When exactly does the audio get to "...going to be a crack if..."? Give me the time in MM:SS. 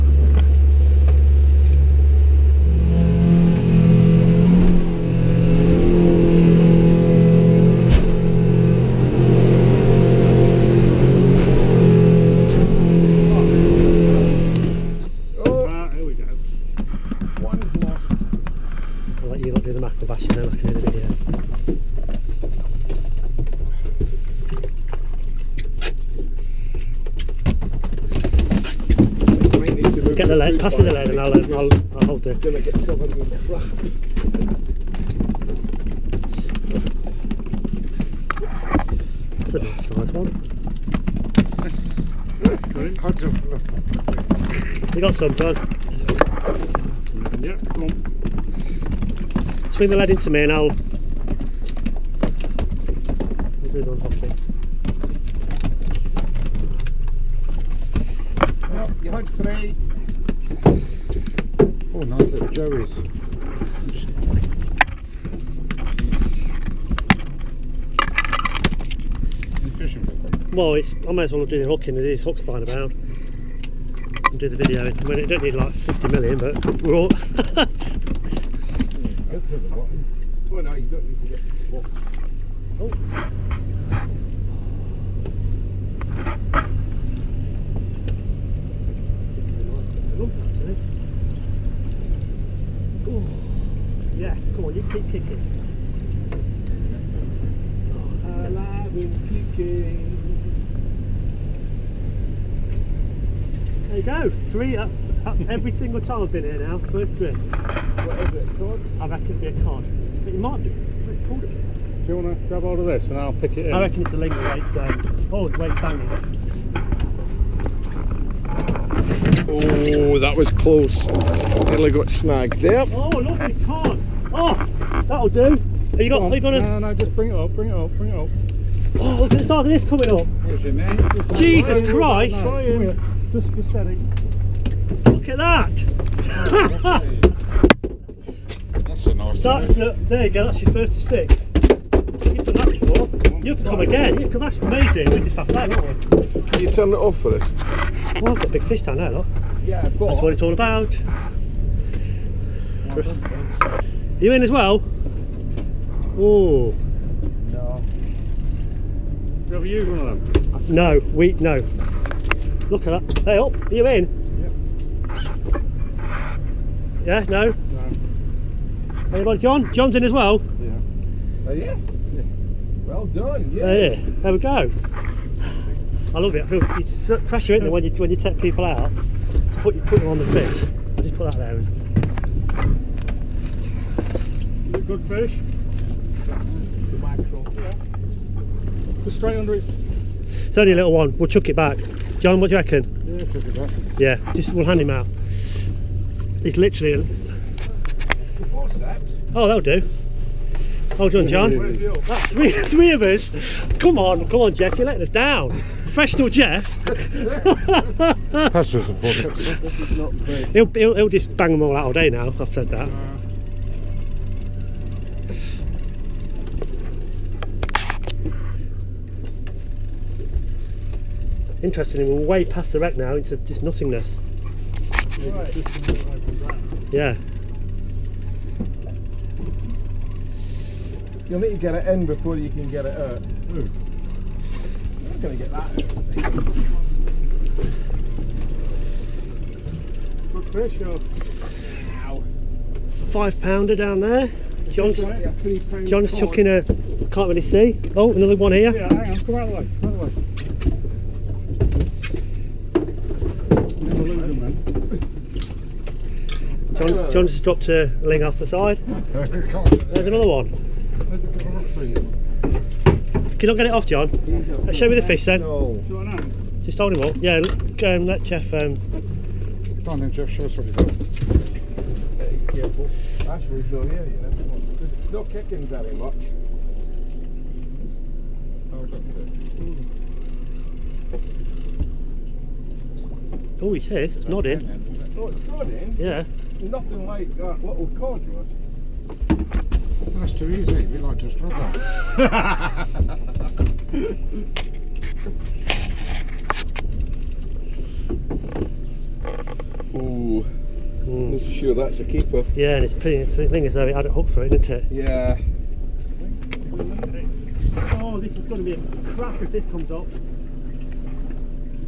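05:08.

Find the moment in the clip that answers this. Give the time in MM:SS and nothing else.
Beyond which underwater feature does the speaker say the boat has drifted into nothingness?
03:42.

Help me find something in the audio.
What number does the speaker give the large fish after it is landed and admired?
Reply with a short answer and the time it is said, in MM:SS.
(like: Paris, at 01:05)
36, at 02:20.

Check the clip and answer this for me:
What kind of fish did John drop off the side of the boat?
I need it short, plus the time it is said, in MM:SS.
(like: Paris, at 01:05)
Ling, at 04:18.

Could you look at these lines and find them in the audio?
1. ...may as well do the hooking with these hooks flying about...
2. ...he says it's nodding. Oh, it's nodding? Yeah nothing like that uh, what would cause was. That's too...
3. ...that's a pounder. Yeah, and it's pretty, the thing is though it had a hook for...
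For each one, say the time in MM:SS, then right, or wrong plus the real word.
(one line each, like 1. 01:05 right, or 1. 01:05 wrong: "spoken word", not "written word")
1. 01:11 right
2. 04:43 right
3. 05:01 wrong: "keeper", not "pounder".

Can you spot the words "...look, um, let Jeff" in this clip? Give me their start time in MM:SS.
04:27.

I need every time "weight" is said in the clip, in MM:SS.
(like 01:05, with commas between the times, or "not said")
01:54.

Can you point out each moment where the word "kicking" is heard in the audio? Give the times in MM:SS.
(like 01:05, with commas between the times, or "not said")
01:35, 01:39, 04:35.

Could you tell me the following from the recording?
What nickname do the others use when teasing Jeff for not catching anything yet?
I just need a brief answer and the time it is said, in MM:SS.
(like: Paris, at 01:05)
Professional Jeff, at 03:25.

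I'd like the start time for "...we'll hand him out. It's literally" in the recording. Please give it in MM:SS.
03:14.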